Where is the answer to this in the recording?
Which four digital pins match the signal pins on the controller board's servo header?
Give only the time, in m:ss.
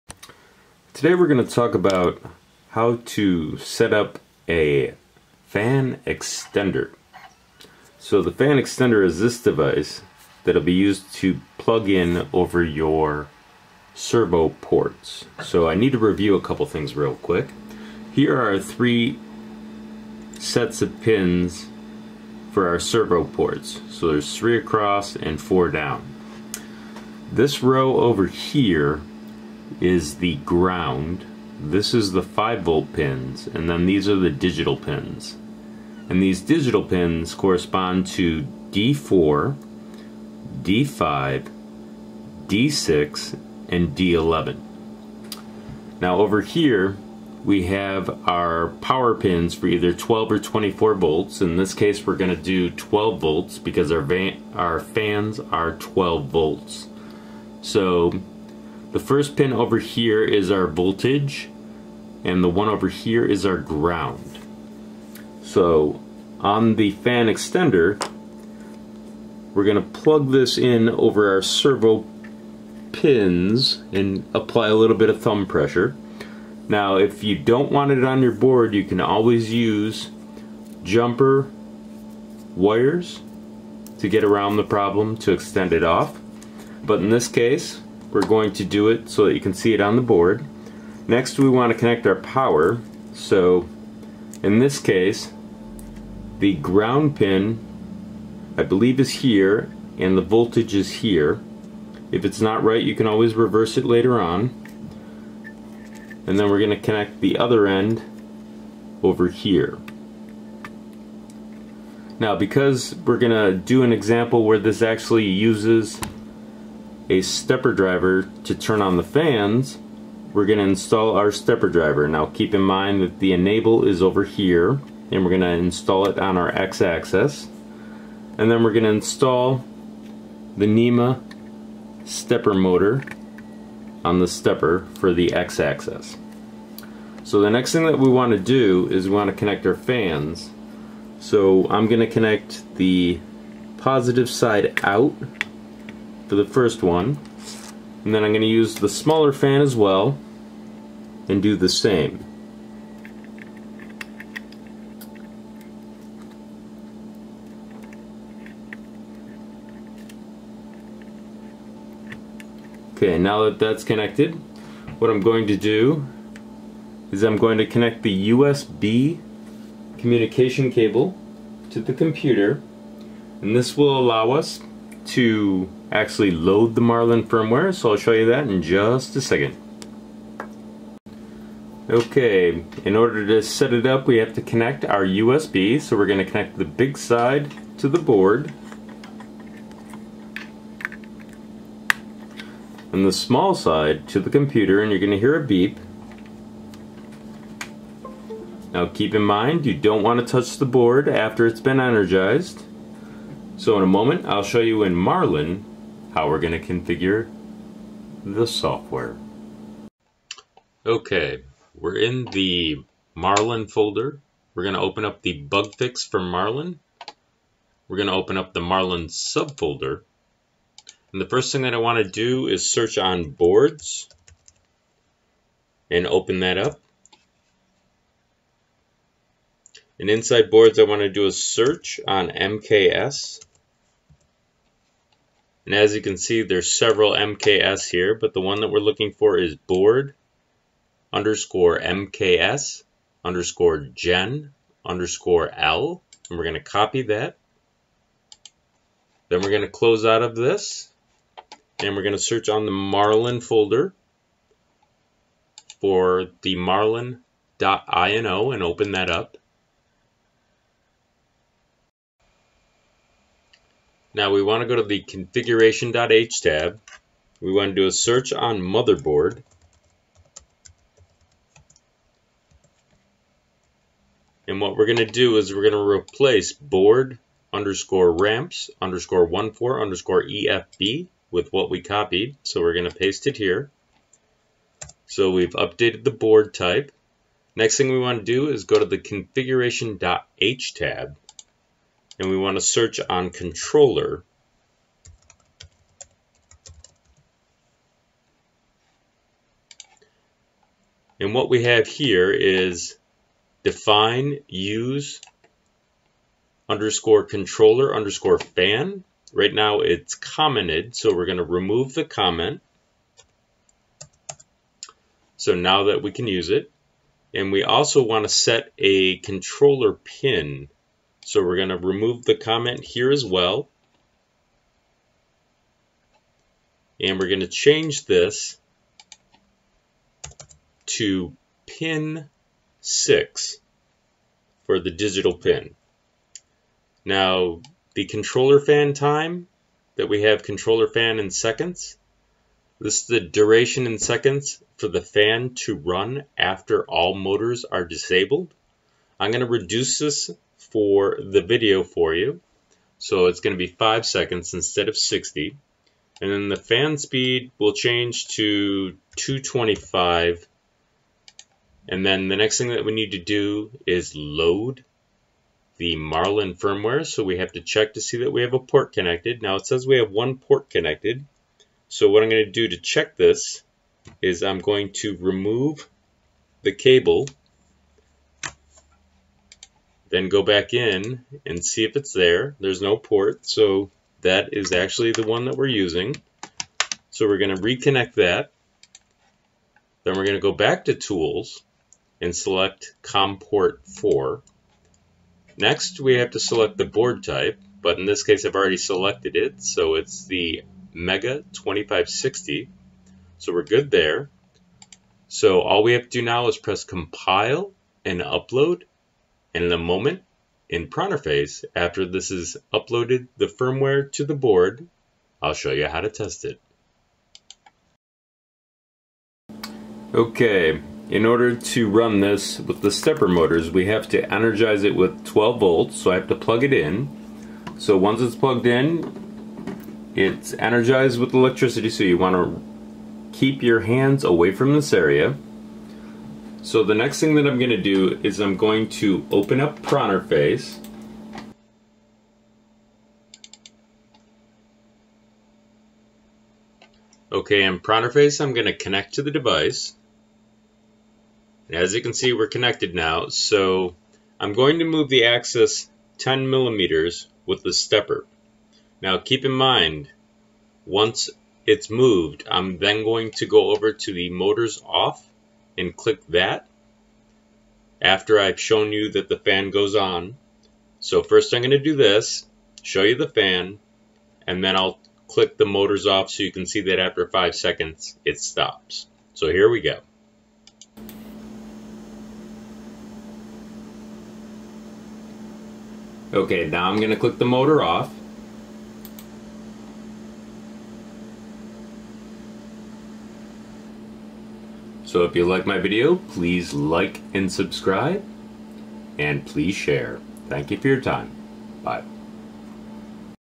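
0:38.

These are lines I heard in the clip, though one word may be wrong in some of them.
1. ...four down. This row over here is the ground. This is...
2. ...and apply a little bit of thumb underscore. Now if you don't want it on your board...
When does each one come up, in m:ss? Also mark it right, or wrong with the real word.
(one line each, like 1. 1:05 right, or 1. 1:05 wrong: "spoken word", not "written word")
1. 0:25 right
2. 1:13 wrong: "pressure", not "underscore".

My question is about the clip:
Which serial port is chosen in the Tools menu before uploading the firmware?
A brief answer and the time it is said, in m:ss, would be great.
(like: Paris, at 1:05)
COM port 4, at 6:33.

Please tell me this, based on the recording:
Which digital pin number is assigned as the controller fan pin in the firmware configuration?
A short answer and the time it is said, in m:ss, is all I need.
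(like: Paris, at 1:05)
6, at 5:31.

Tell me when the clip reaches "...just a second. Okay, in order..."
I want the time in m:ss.
2:58.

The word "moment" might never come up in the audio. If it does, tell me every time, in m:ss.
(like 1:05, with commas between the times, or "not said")
3:24, 6:49.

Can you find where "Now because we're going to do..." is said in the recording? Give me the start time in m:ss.
1:52.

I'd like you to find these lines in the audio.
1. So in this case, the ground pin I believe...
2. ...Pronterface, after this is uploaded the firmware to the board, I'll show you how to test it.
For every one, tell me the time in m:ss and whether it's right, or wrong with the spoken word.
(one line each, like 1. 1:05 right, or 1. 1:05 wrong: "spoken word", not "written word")
1. 1:33 right
2. 6:50 right.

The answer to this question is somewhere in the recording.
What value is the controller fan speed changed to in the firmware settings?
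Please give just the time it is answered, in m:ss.
5:59.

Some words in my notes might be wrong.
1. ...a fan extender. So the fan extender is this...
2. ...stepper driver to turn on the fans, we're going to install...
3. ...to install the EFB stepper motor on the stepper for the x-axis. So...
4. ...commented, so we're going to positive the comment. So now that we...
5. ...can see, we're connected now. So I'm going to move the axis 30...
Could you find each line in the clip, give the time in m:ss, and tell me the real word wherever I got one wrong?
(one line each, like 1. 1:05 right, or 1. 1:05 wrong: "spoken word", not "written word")
1. 0:04 right
2. 1:57 right
3. 2:08 wrong: "NEMA", not "EFB"
4. 5:10 wrong: "remove", not "positive"
5. 7:32 wrong: "10", not "30".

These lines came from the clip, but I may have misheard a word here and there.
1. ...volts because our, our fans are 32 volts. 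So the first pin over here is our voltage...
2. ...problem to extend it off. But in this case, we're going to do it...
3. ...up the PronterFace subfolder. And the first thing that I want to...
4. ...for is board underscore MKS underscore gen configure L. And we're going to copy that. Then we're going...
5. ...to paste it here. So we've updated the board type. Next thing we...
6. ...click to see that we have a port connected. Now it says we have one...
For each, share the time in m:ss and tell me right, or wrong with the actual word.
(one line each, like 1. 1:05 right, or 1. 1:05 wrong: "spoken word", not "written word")
1. 0:53 wrong: "12", not "32"
2. 1:24 right
3. 3:38 wrong: "Marlin", not "PronterFace"
4. 3:59 wrong: "underscore", not "configure"
5. 4:42 right
6. 6:07 wrong: "check", not "click".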